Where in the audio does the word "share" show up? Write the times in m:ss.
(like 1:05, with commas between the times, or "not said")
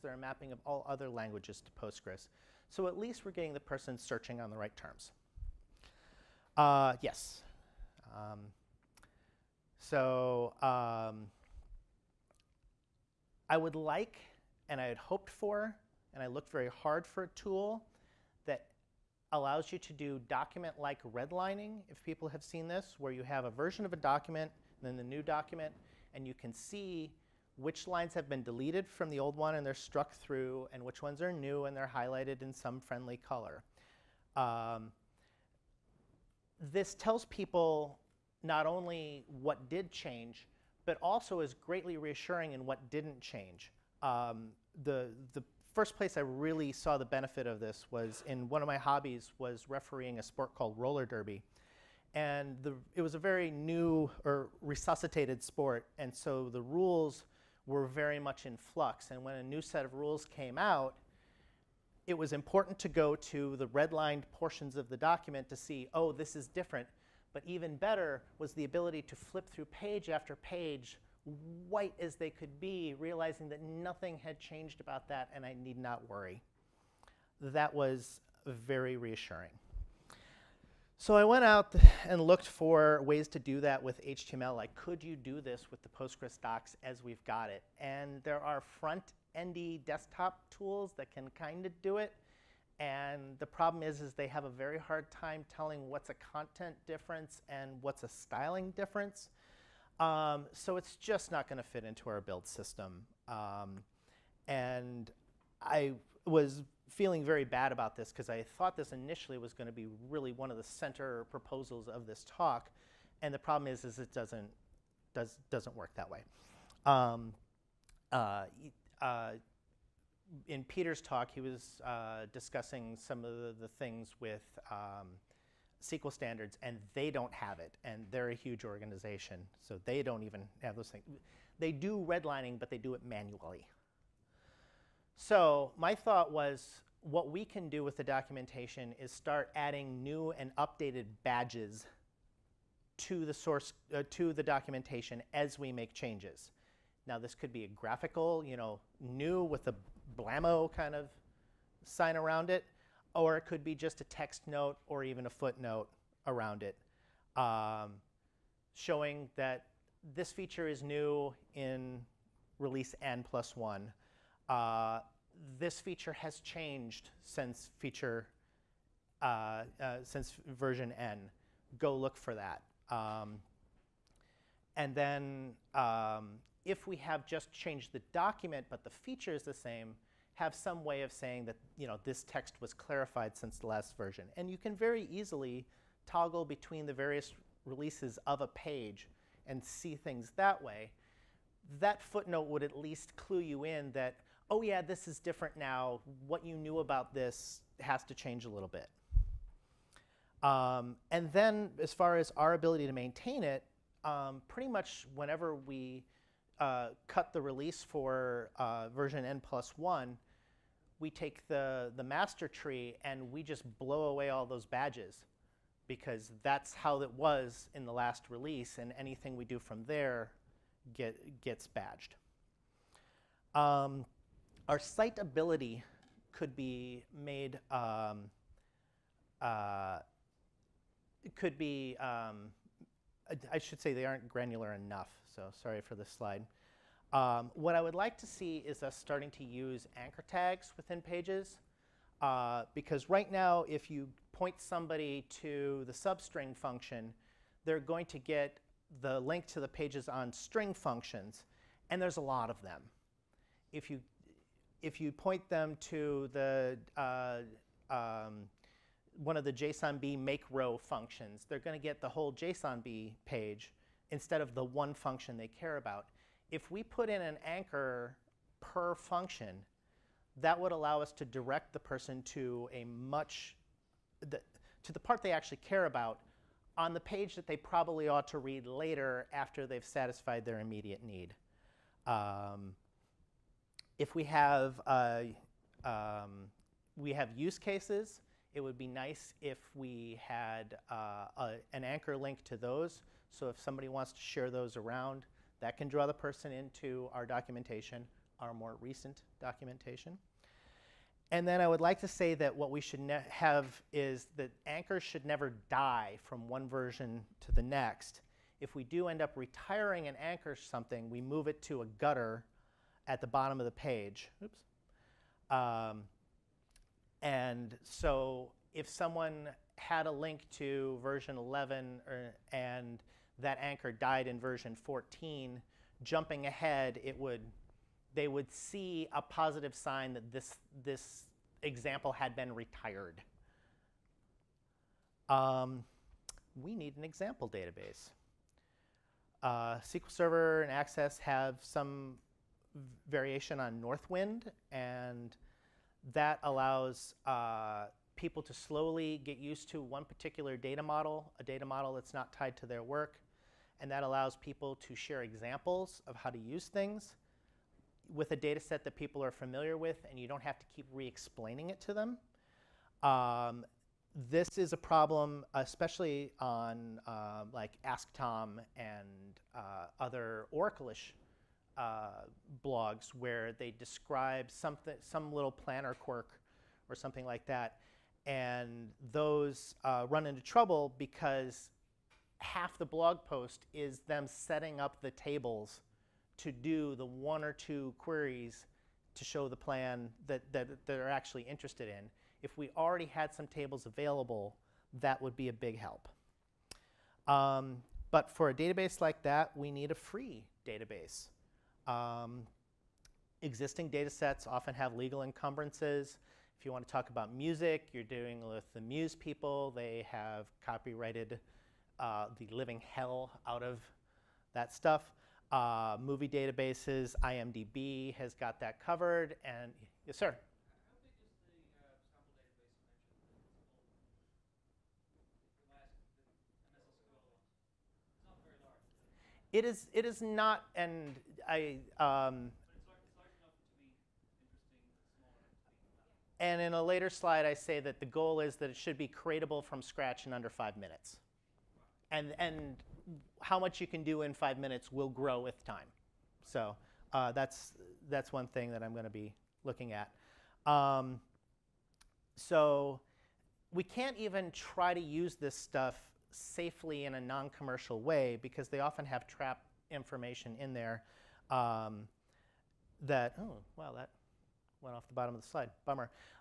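4:54, 5:54.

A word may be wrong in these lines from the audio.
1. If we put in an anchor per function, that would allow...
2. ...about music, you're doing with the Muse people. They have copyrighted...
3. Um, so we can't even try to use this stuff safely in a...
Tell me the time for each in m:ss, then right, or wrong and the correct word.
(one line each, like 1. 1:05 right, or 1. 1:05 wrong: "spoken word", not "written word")
1. 4:26 right
2. 6:47 right
3. 7:30 right.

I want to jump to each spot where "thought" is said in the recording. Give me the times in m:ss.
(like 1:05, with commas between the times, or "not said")
1:48, 2:15.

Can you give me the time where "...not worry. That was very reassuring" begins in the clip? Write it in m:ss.
1:15.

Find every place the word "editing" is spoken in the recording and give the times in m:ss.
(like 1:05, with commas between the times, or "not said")
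not said.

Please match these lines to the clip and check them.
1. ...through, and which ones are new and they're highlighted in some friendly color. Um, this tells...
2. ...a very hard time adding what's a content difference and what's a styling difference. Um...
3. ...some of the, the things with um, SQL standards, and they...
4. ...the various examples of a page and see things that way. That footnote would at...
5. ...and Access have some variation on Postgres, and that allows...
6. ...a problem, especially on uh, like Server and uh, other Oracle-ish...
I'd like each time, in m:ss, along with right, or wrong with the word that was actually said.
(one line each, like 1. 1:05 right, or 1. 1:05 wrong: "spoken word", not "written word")
1. 0:30 right
2. 1:34 wrong: "telling", not "adding"
3. 2:02 right
4. 3:06 wrong: "releases", not "examples"
5. 5:40 wrong: "Northwind", not "Postgres"
6. 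6:04 wrong: "Tom", not "Server".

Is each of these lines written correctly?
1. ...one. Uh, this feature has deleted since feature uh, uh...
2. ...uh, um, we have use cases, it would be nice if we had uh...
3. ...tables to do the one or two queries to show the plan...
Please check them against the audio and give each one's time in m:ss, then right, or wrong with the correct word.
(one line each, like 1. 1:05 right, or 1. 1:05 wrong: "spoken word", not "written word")
1. 2:43 wrong: "changed", not "deleted"
2. 4:44 right
3. 6:25 right.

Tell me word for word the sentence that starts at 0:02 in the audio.
So at least we're getting the person searching on the right terms.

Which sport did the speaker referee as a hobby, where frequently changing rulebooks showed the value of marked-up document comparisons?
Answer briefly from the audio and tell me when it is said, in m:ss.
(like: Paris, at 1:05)
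Roller derby, at 0:50.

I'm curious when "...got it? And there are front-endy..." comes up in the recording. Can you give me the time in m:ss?
1:27.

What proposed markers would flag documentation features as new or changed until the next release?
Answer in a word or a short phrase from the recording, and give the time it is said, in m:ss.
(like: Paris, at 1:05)
New and updated badges, at 2:20.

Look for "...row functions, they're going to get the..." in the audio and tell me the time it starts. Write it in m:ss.
4:20.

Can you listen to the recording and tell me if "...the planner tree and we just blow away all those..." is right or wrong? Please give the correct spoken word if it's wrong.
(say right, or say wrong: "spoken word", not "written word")
wrong: "master", not "planner".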